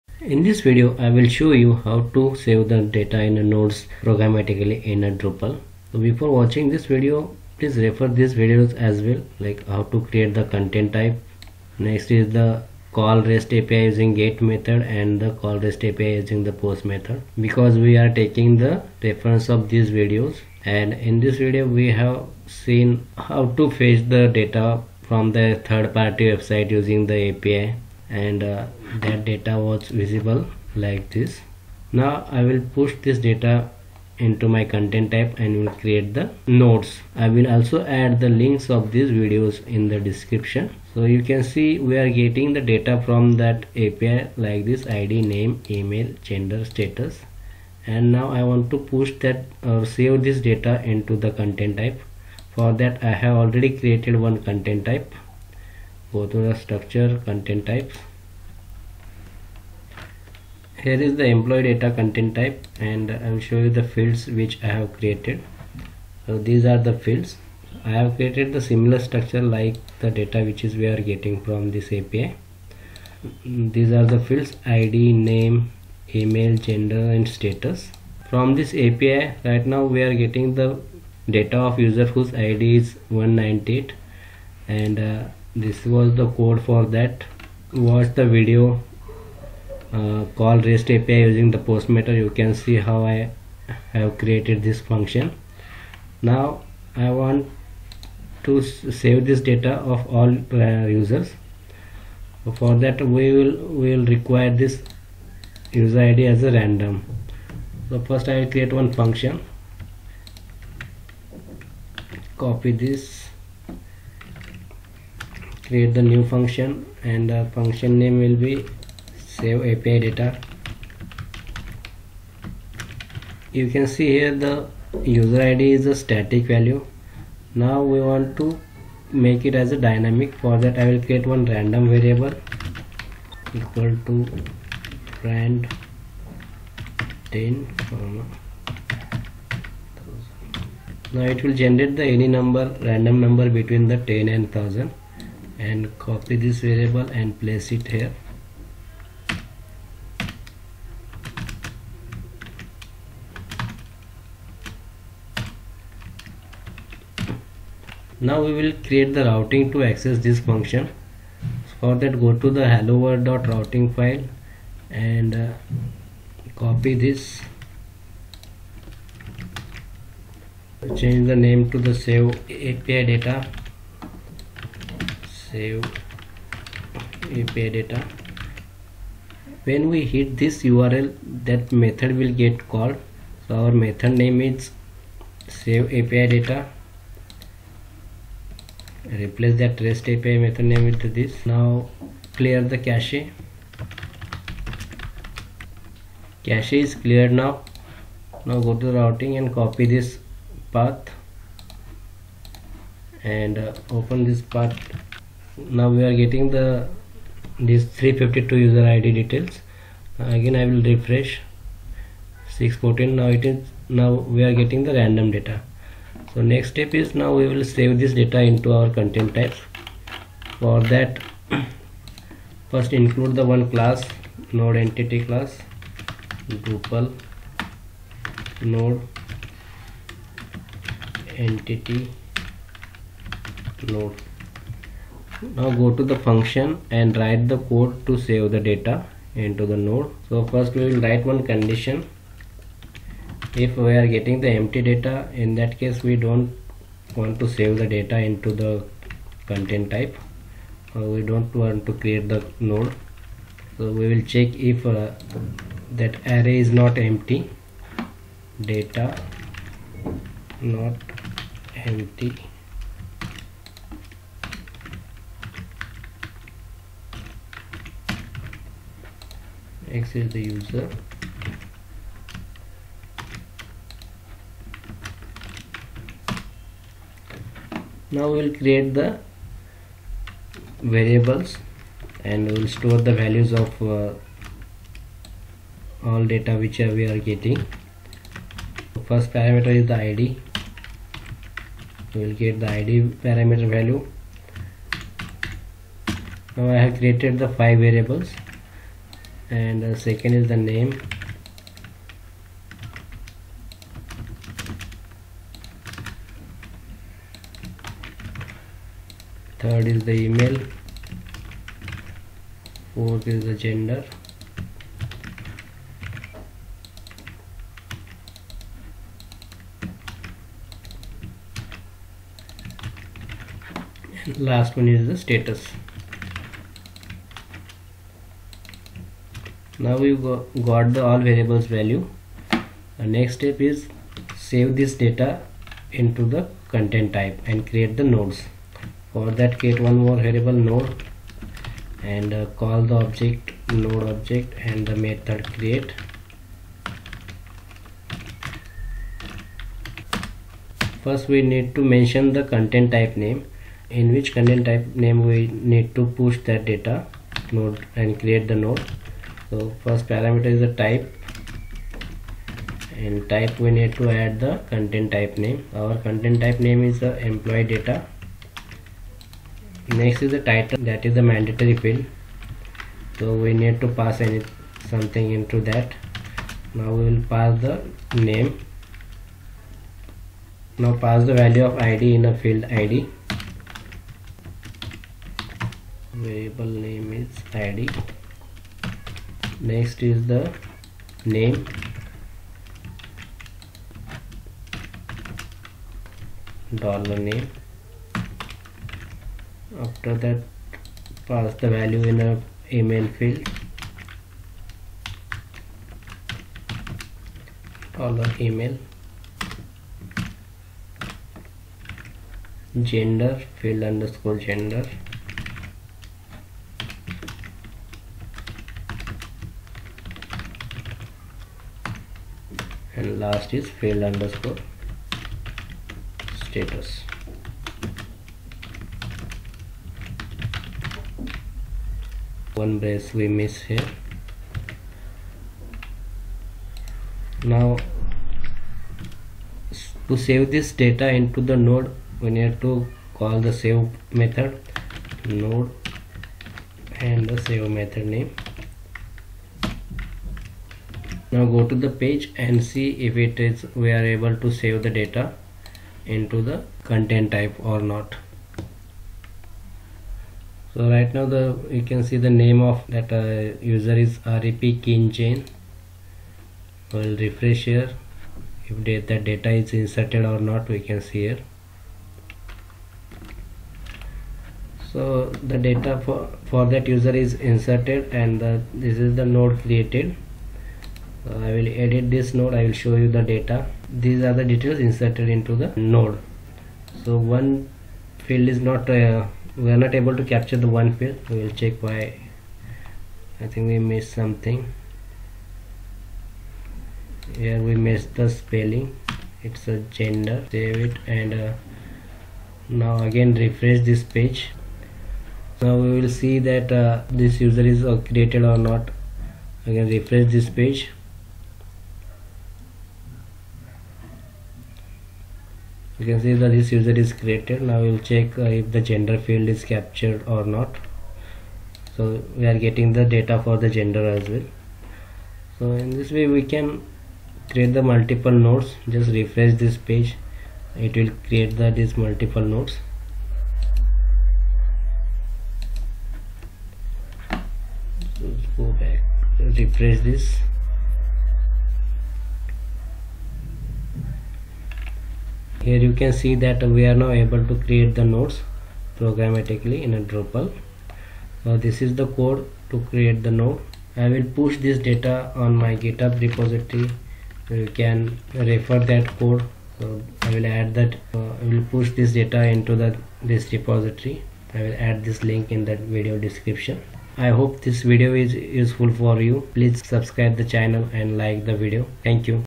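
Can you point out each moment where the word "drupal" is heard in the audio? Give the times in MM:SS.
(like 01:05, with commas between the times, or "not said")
00:05, 03:46, 09:10.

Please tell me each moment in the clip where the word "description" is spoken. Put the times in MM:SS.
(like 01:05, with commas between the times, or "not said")
00:39, 09:26.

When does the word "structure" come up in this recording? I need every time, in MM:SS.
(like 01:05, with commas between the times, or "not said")
00:56, 01:08.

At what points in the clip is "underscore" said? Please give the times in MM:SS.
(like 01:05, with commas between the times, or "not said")
06:53, 07:04.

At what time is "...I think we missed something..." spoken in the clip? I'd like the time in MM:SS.
08:13.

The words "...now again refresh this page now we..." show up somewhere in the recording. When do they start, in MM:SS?
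08:22.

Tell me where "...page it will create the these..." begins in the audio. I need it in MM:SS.
08:49.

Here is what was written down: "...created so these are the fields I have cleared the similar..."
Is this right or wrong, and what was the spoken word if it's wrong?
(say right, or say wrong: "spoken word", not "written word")
wrong: "created", not "cleared".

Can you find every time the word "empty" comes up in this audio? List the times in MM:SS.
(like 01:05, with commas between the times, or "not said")
04:04, 04:16, 04:21.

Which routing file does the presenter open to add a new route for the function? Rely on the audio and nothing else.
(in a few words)
hello world routing file.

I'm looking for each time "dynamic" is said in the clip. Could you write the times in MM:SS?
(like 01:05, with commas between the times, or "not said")
02:09.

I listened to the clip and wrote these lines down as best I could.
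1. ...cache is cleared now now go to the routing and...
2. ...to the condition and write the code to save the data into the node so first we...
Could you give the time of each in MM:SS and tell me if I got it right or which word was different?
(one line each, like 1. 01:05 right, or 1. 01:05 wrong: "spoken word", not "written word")
1. 03:16 right
2. 03:55 wrong: "function", not "condition".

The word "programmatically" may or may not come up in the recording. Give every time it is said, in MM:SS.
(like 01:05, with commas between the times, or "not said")
00:04, 09:08.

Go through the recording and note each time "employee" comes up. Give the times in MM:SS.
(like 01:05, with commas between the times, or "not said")
01:01, 06:07.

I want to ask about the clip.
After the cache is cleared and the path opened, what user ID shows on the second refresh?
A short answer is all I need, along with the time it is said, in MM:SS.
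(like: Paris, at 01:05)
614, at 03:32.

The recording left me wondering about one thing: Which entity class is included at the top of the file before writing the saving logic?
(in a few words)
node entity class.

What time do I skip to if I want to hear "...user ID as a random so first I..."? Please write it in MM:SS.
01:45.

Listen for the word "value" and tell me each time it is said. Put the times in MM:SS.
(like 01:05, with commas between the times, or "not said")
02:06, 04:43, 04:53, 05:31, 06:21, 06:41.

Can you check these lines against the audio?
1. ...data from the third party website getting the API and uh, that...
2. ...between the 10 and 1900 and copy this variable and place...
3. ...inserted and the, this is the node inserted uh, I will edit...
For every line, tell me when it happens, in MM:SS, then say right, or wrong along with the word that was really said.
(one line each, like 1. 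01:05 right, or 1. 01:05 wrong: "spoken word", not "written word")
1. 00:24 wrong: "using", not "getting"
2. 02:23 wrong: "1000", not "1900"
3. 07:57 wrong: "created", not "inserted".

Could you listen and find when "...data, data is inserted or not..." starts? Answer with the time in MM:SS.
07:48.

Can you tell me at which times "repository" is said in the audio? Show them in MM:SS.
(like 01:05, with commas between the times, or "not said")
09:16, 09:23.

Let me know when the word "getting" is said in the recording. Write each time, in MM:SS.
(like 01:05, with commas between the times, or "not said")
00:42, 01:11, 01:20, 03:26, 03:34, 04:04, 04:47, 08:42.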